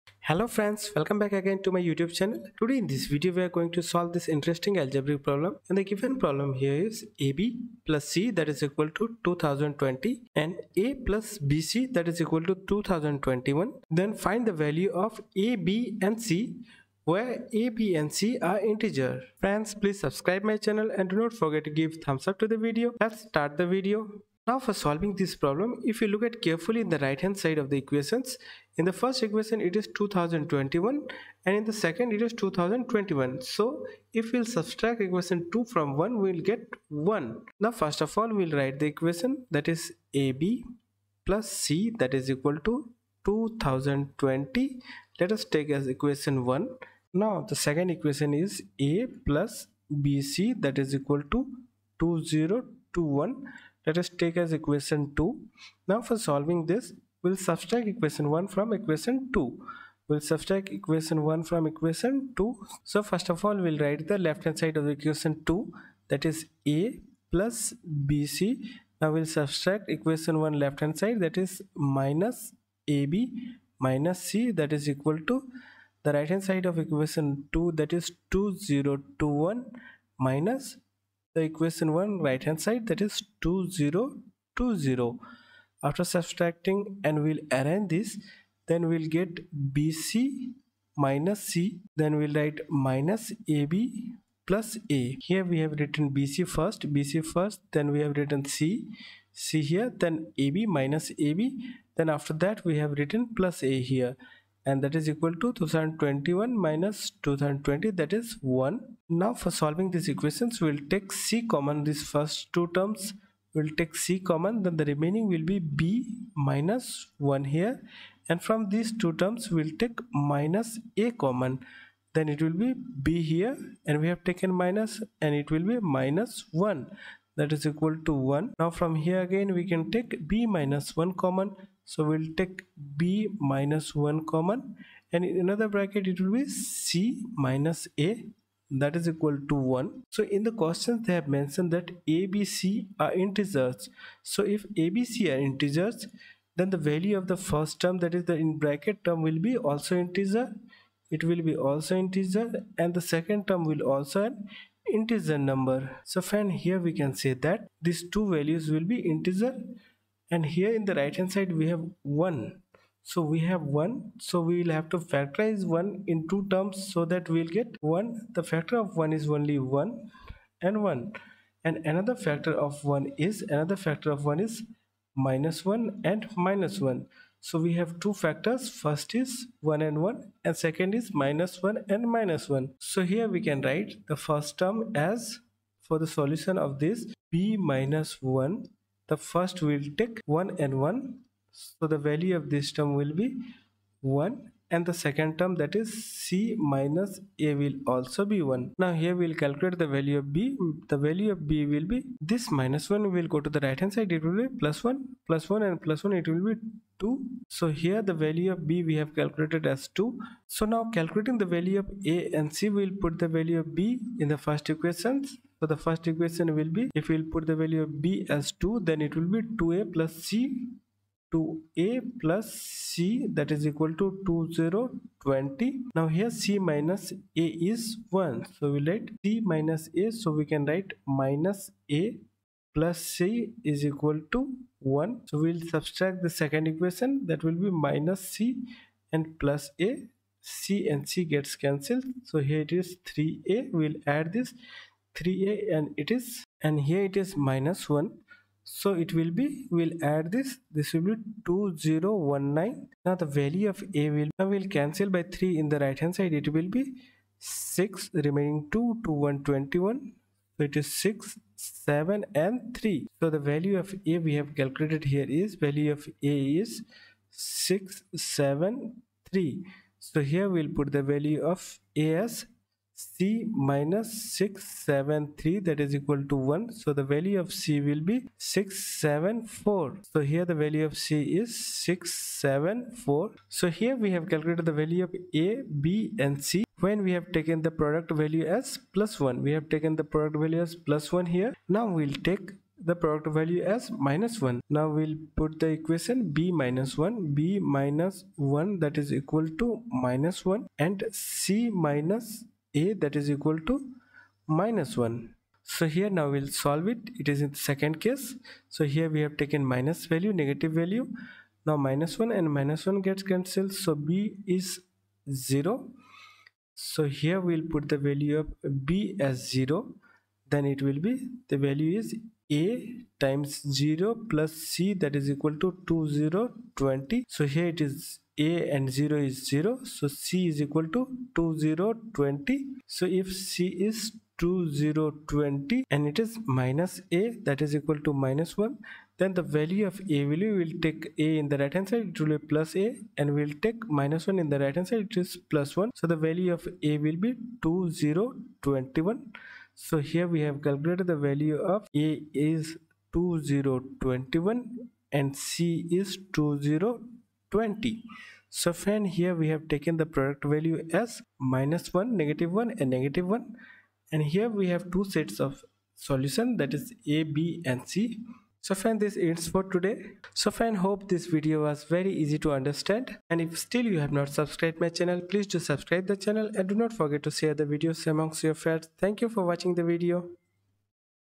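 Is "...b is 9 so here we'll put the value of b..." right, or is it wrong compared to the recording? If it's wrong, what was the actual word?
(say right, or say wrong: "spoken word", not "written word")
wrong: "0", not "9".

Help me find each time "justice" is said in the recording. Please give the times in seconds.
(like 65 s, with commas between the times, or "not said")
not said.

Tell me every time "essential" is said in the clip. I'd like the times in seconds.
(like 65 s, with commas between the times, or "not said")
not said.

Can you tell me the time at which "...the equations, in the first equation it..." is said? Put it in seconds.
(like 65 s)
27 s.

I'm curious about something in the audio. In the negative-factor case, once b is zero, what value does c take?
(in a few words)
2020.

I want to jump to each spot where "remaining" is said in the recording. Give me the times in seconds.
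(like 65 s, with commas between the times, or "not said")
114 s, 258 s.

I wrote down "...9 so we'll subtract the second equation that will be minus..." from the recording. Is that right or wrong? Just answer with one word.
wrong.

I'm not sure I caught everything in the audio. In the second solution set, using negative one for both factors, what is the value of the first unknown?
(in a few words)
2021.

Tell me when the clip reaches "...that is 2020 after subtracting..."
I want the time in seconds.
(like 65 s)
82 s.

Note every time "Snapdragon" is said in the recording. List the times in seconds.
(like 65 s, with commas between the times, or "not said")
not said.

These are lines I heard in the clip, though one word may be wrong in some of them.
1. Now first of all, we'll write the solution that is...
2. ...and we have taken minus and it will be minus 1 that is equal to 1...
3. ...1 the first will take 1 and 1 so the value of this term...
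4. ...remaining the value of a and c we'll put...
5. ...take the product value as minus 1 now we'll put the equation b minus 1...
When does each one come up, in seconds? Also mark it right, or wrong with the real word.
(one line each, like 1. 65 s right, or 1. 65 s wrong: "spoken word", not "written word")
1. 37 s wrong: "equation", not "solution"
2. 123 s right
3. 188 s right
4. 210 s wrong: "calculating", not "remaining"
5. 292 s right.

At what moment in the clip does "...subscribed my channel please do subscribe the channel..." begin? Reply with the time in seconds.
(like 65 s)
374 s.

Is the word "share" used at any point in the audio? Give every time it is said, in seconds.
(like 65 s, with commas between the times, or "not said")
377 s.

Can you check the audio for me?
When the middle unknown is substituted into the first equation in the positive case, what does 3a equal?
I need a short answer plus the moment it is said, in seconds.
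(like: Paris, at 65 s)
2019, at 251 s.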